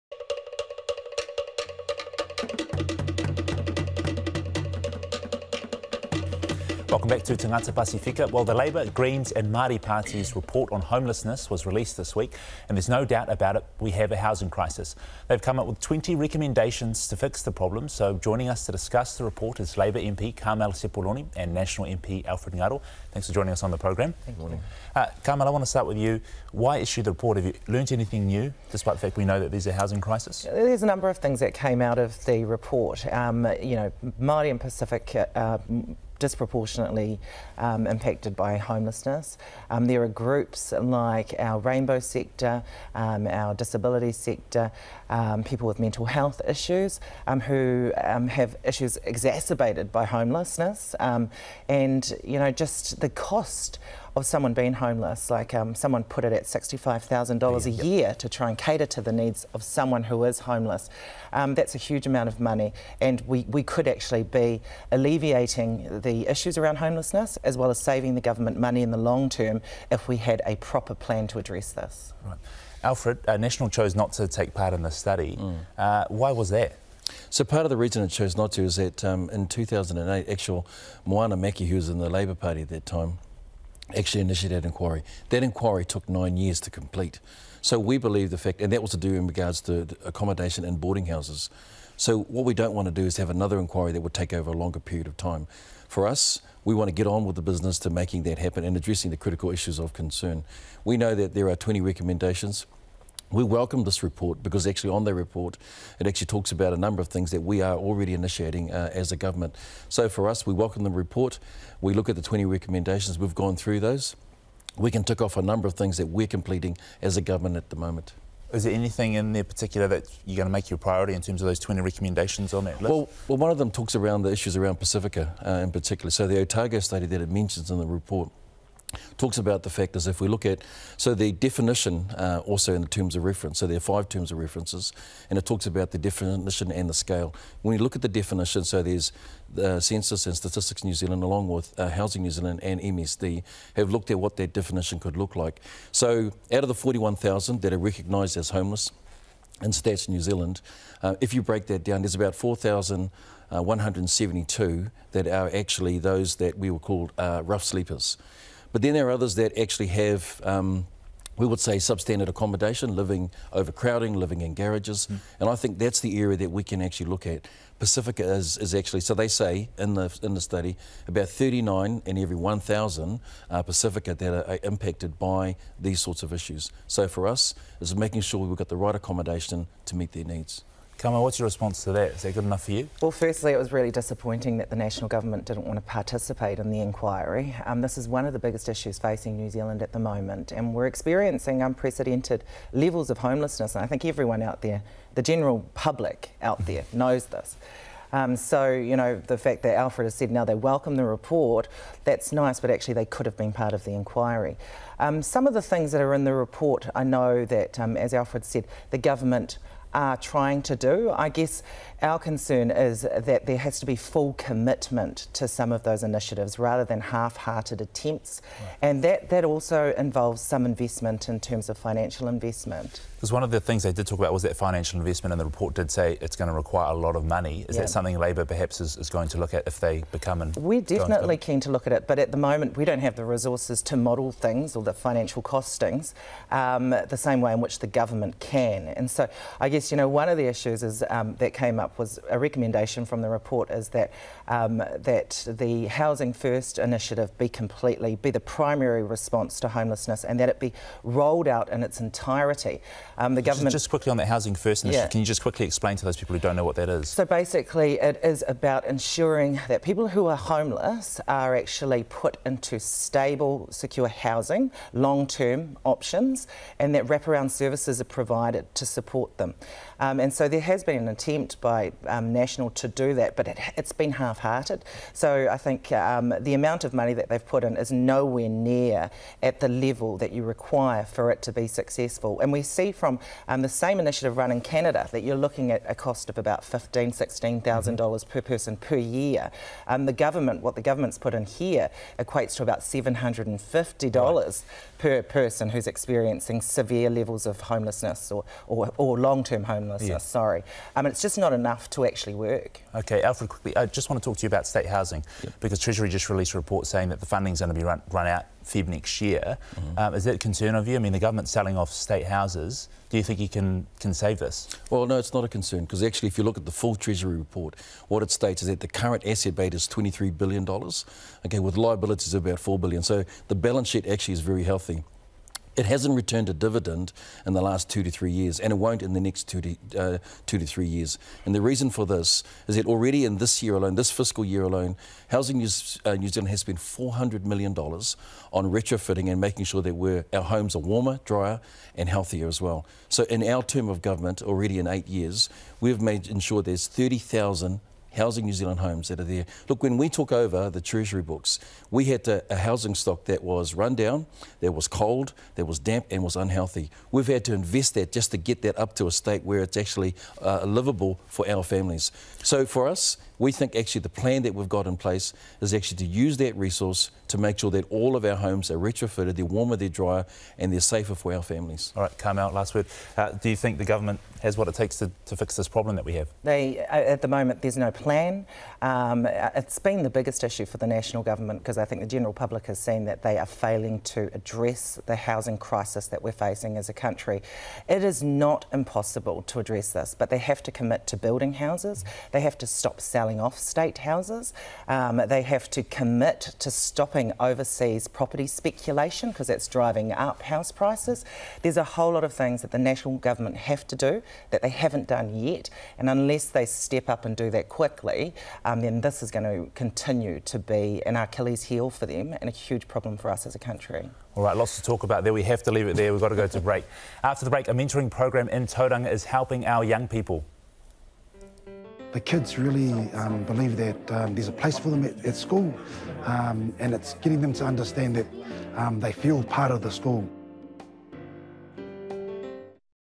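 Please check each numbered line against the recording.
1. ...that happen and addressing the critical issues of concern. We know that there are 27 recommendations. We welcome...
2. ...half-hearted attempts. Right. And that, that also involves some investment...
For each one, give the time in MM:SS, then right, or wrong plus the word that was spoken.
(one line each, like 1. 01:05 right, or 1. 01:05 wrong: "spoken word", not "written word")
1. 01:38 wrong: "20", not "27"
2. 03:37 right.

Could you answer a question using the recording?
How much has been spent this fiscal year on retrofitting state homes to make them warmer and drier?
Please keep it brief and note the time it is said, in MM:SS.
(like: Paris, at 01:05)
$400 million, at 05:36.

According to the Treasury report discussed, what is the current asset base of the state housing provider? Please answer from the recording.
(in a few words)
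$23 billion.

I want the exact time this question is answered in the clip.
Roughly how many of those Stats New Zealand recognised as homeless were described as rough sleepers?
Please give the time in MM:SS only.
02:32.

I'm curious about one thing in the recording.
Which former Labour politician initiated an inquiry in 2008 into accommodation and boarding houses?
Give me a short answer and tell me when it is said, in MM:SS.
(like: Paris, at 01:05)
Moana Mackey, at 01:21.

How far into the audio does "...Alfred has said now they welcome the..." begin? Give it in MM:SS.
03:19.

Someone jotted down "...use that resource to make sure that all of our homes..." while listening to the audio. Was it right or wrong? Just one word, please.
right.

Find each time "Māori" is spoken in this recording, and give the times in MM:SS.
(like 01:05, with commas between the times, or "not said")
00:09, 00:34.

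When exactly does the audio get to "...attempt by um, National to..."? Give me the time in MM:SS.
04:31.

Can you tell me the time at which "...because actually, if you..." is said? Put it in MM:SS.
05:15.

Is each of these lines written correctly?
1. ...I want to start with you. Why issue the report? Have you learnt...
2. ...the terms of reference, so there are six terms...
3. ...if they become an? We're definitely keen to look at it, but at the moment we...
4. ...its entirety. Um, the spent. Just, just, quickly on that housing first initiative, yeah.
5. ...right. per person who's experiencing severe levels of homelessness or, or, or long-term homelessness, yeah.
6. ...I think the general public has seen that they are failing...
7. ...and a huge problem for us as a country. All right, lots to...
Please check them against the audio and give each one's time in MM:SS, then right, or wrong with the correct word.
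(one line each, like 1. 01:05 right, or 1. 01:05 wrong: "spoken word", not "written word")
1. 00:25 right
2. 02:12 wrong: "five", not "six"
3. 03:49 right
4. 04:11 wrong: "government", not "spent"
5. 04:54 right
6. 06:21 right
7. 06:52 right.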